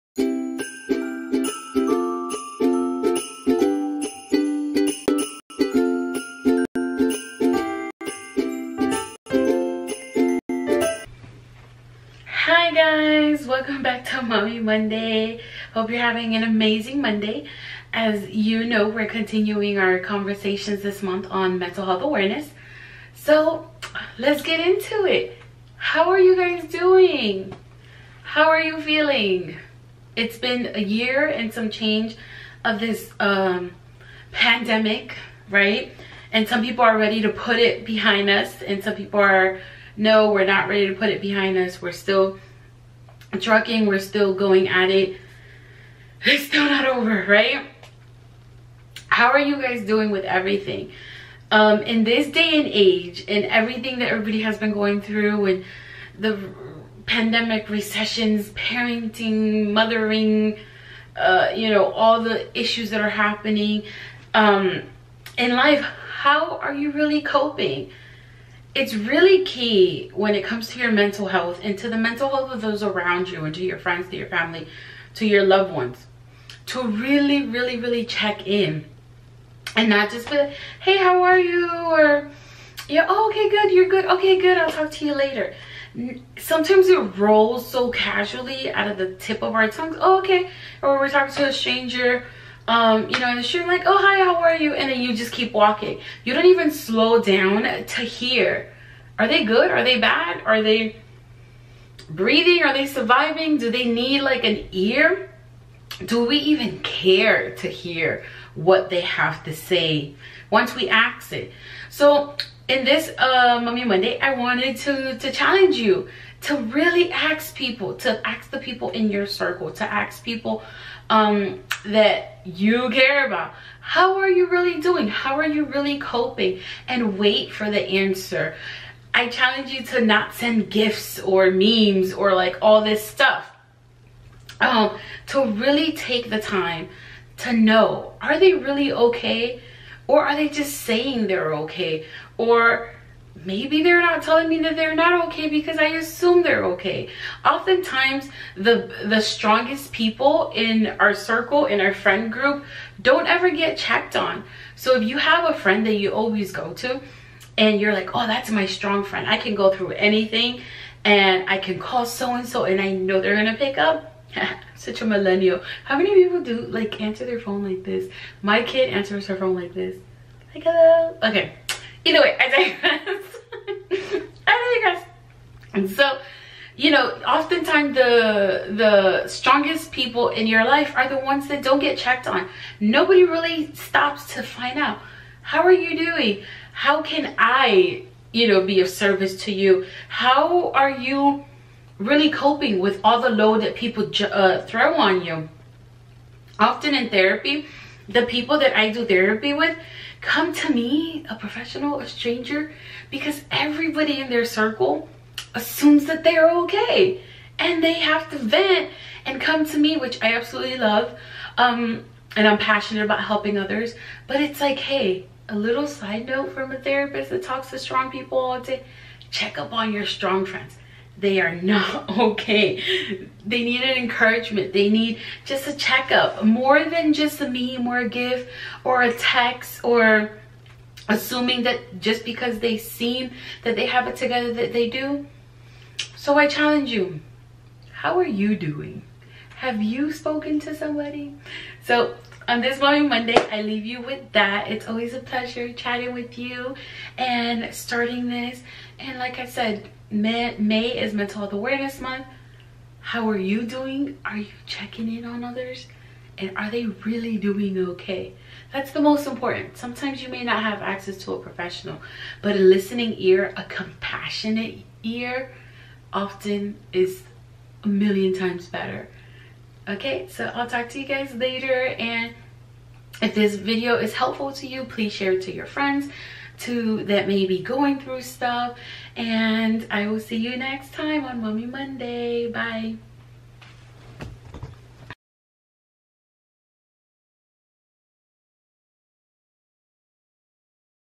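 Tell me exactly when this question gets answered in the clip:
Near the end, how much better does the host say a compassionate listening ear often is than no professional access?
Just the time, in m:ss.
4:27.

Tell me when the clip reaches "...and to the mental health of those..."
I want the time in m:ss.
1:11.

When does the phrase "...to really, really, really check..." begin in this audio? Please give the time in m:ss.
1:16.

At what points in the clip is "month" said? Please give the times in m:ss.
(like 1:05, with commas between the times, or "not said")
0:21, 4:12.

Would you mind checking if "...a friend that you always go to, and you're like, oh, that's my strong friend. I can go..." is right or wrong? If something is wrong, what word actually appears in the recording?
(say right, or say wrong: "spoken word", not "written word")
right.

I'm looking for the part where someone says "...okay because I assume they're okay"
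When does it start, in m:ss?
2:25.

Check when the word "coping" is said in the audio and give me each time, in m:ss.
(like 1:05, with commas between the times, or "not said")
1:07, 2:05, 3:12.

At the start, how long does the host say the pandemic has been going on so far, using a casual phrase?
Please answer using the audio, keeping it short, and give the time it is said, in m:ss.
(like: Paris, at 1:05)
a year and some change, at 0:30.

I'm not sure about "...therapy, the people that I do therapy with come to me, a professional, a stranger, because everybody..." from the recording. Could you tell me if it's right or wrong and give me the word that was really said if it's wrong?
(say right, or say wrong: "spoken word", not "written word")
right.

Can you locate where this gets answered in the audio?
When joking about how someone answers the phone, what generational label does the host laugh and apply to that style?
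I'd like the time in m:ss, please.
2:45.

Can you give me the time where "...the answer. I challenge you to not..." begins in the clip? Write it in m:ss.
2:07.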